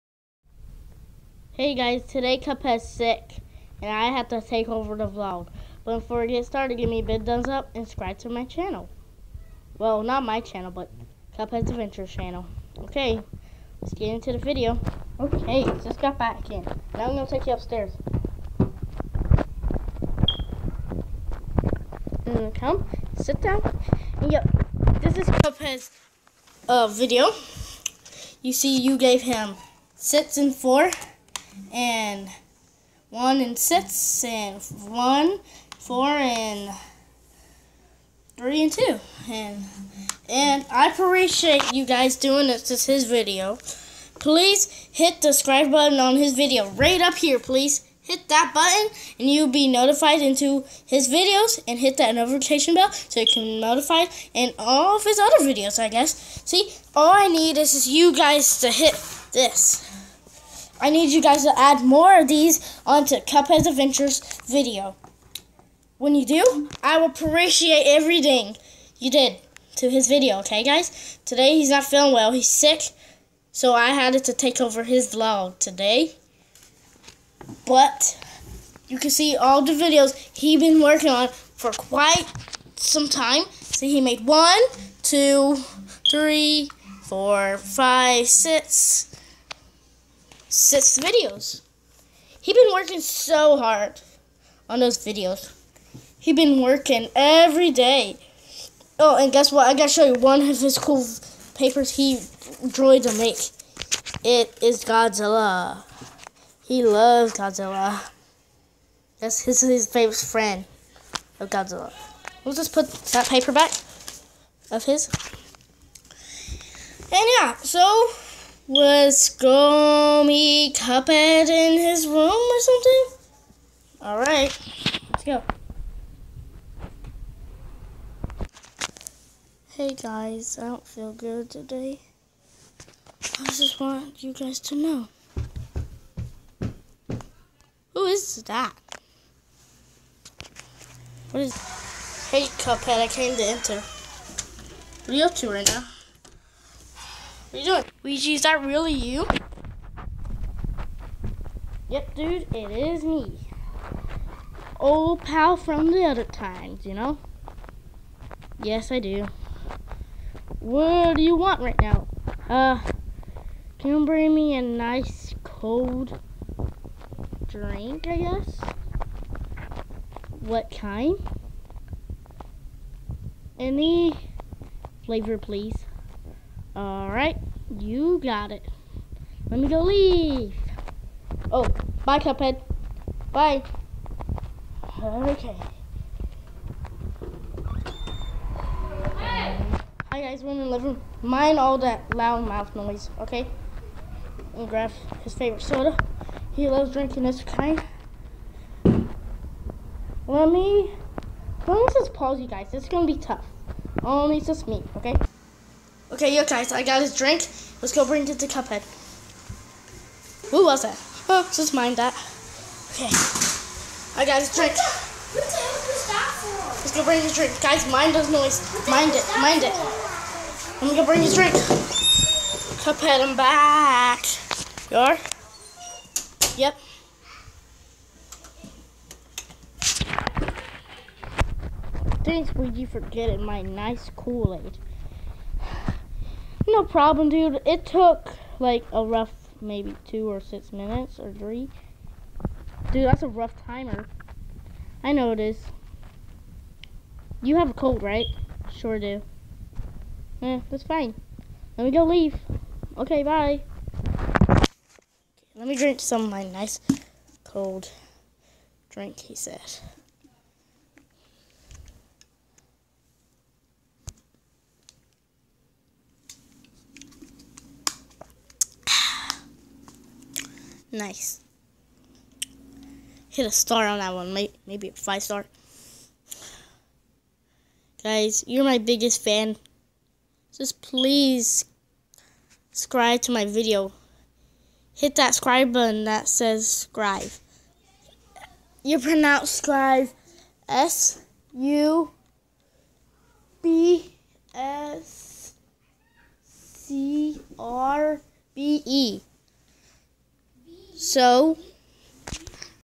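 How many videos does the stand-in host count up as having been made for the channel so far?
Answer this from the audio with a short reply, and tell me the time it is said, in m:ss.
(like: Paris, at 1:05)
6, at 1:30.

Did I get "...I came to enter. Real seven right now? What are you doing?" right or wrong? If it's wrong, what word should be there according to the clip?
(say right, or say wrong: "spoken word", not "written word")
wrong: "two", not "seven".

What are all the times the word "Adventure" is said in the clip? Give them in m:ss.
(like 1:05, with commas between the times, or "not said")
0:11, 1:03.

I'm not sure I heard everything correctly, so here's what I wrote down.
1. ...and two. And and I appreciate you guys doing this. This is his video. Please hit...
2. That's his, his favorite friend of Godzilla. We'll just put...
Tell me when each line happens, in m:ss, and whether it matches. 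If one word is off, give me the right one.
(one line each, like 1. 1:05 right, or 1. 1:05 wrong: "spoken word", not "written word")
1. 0:38 right
2. 1:49 right.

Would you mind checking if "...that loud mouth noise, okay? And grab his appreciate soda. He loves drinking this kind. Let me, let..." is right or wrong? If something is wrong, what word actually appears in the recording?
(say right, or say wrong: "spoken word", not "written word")
wrong: "favorite", not "appreciate".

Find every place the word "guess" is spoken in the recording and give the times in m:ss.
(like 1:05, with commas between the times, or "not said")
0:55, 1:39, 2:48.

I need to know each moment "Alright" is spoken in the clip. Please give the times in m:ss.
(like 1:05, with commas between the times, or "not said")
2:04, 2:56.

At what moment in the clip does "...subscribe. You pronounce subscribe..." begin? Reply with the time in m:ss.
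4:46.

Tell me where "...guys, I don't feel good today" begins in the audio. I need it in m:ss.
2:09.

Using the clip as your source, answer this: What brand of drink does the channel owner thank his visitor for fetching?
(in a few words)
Kool-Aid.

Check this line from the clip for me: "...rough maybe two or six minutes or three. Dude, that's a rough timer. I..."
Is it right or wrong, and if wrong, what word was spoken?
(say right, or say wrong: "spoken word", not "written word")
right.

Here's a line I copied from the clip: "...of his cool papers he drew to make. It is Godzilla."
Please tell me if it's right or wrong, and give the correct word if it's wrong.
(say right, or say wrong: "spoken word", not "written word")
right.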